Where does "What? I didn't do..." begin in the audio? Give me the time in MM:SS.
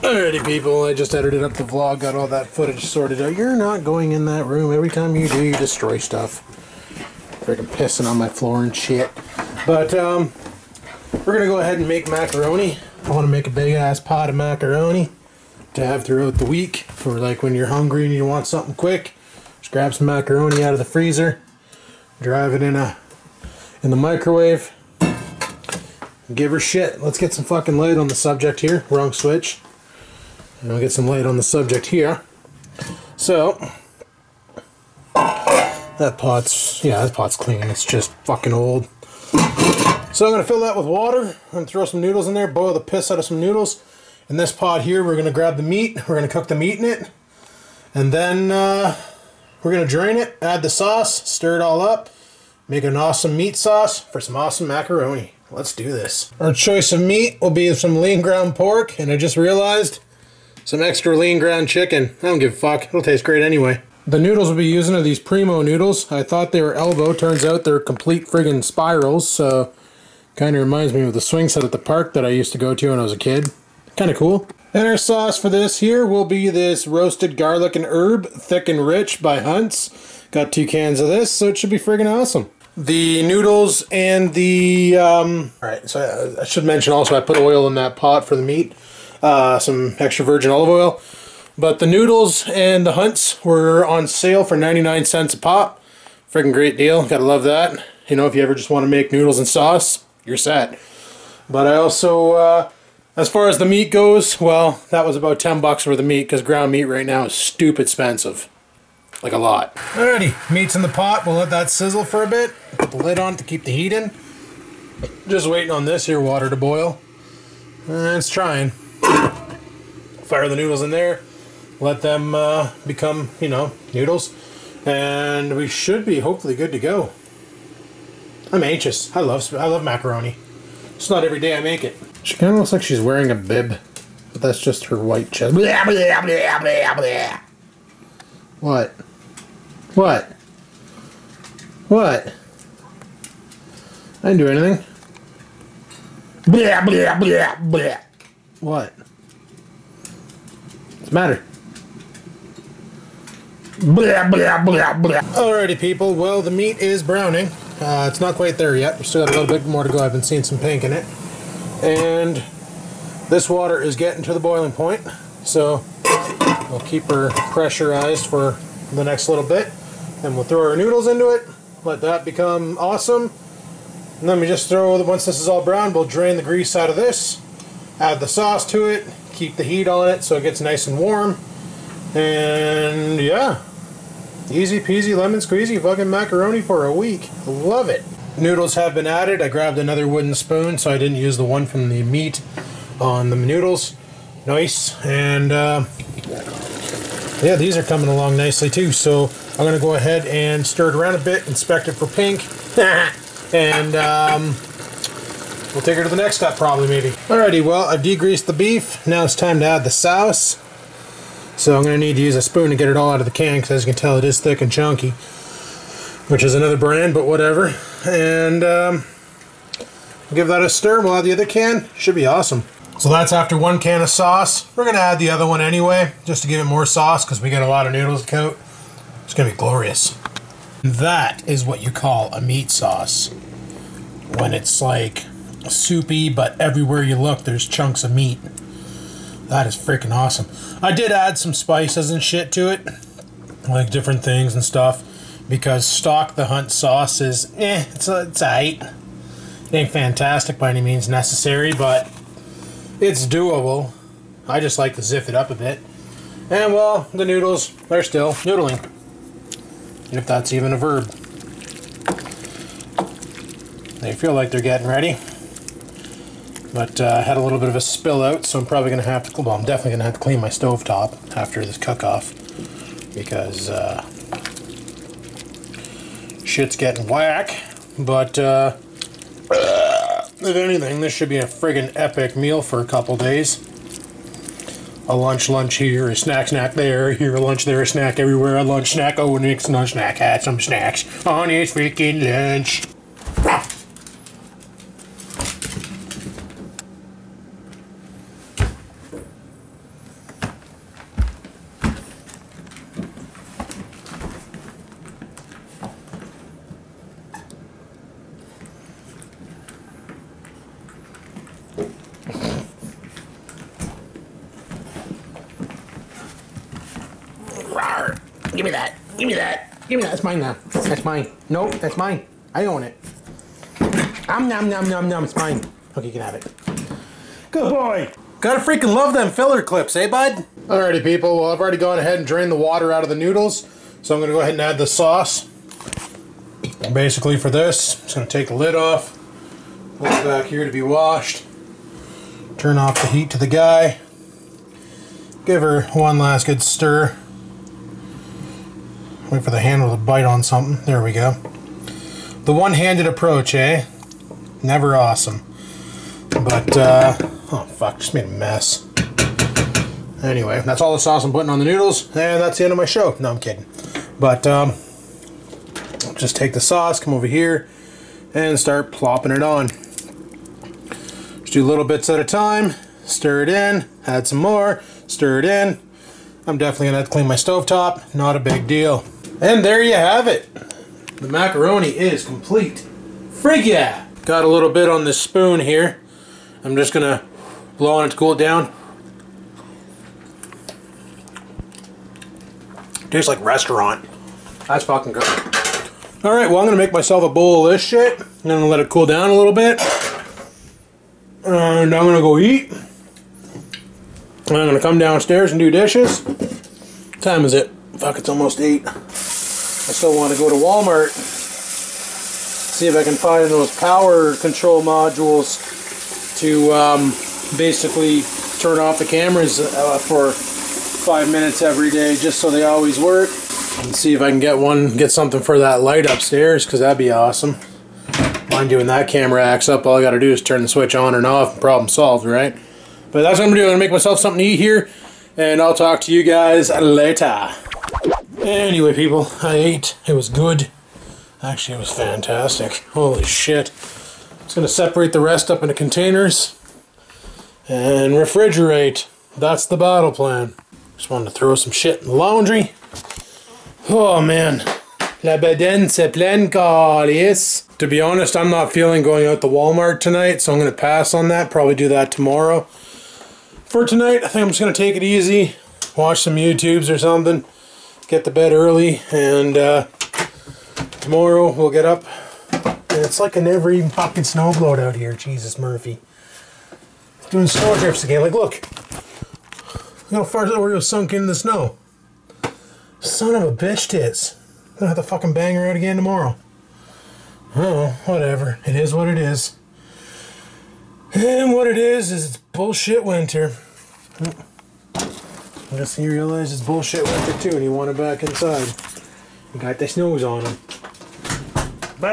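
02:21.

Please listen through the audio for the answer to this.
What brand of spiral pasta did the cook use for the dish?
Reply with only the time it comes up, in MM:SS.
01:05.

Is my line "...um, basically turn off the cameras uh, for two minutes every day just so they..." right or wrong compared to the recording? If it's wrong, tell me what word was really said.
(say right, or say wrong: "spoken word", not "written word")
wrong: "five", not "two".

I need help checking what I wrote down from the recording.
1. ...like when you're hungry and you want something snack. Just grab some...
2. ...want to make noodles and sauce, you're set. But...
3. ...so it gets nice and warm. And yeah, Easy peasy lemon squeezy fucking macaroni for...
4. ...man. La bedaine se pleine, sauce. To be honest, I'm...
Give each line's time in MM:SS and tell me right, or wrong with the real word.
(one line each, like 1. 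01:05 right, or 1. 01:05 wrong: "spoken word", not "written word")
1. 00:17 wrong: "quick", not "snack"
2. 01:38 right
3. 03:00 right
4. 07:34 wrong: "calice", not "sauce".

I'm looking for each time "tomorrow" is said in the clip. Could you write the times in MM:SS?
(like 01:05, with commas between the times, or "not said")
07:42, 07:51, 08:05.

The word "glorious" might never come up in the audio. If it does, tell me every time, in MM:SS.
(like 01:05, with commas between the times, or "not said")
03:49.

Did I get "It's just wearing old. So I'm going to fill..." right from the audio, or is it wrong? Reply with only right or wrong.
wrong.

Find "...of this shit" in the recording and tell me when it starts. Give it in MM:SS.
06:37.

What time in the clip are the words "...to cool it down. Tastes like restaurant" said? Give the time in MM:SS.
06:28.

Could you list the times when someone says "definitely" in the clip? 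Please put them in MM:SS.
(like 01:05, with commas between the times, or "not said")
04:29, 06:16.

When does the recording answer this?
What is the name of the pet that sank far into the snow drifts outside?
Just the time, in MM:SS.
08:00.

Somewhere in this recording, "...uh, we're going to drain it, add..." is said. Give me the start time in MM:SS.
00:48.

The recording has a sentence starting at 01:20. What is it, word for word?
Got two cans of this, so it should be friggin' awesome.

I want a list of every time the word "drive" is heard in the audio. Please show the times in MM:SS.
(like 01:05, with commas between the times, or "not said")
00:22.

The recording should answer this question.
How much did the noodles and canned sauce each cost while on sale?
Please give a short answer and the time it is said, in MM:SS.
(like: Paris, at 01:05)
99 cents, at 01:34.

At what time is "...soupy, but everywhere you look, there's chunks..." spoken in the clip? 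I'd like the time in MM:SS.
03:55.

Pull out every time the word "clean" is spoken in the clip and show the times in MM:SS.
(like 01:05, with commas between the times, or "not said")
00:37, 04:30, 06:17.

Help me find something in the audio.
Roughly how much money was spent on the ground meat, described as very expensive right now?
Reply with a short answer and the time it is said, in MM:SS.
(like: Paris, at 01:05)
10 bucks, at 01:45.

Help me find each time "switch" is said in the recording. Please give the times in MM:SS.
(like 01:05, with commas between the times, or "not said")
00:29, 07:10.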